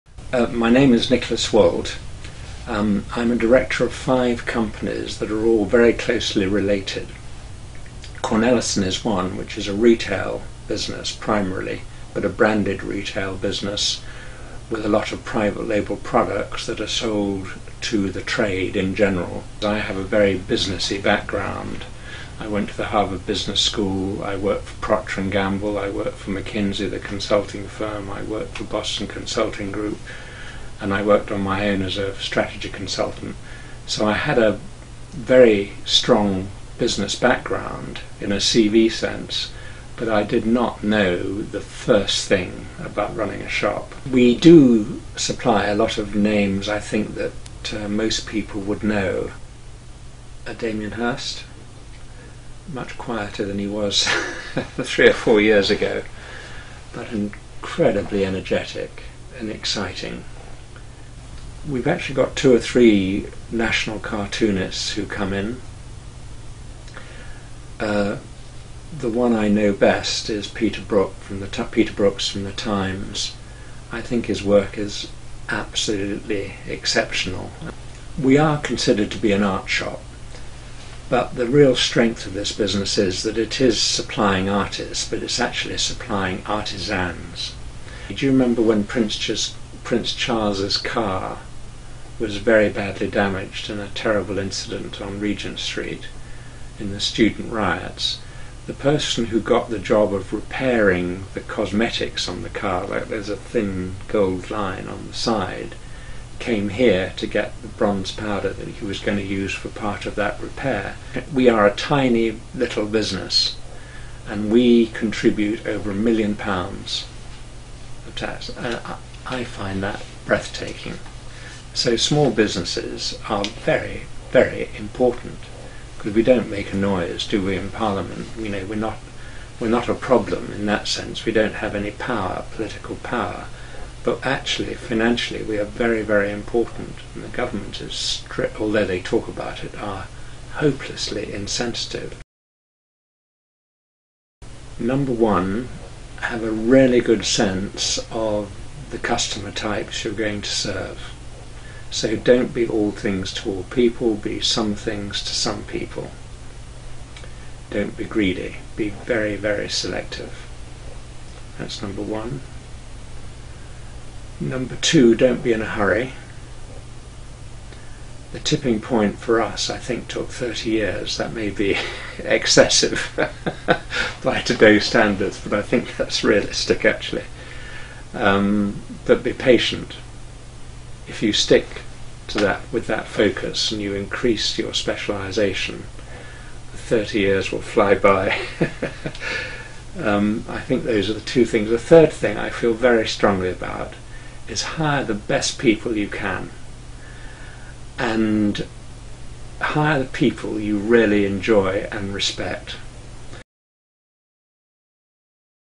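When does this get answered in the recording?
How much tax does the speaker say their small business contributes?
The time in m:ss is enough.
1:55.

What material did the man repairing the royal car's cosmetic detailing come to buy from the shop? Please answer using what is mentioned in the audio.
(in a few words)
bronze powder.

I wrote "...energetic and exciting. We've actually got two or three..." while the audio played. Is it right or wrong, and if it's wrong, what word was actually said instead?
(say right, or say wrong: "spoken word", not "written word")
right.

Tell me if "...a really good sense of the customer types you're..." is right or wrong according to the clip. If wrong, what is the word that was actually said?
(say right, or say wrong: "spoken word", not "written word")
right.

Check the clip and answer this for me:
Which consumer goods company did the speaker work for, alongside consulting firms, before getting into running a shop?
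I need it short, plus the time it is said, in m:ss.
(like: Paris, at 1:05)
Procter and Gamble, at 0:24.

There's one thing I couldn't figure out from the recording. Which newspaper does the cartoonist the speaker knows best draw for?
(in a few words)
The Times.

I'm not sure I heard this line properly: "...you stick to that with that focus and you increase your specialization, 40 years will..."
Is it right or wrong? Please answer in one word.
wrong.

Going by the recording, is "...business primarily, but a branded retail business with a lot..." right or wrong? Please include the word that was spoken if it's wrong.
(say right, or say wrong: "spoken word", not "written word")
right.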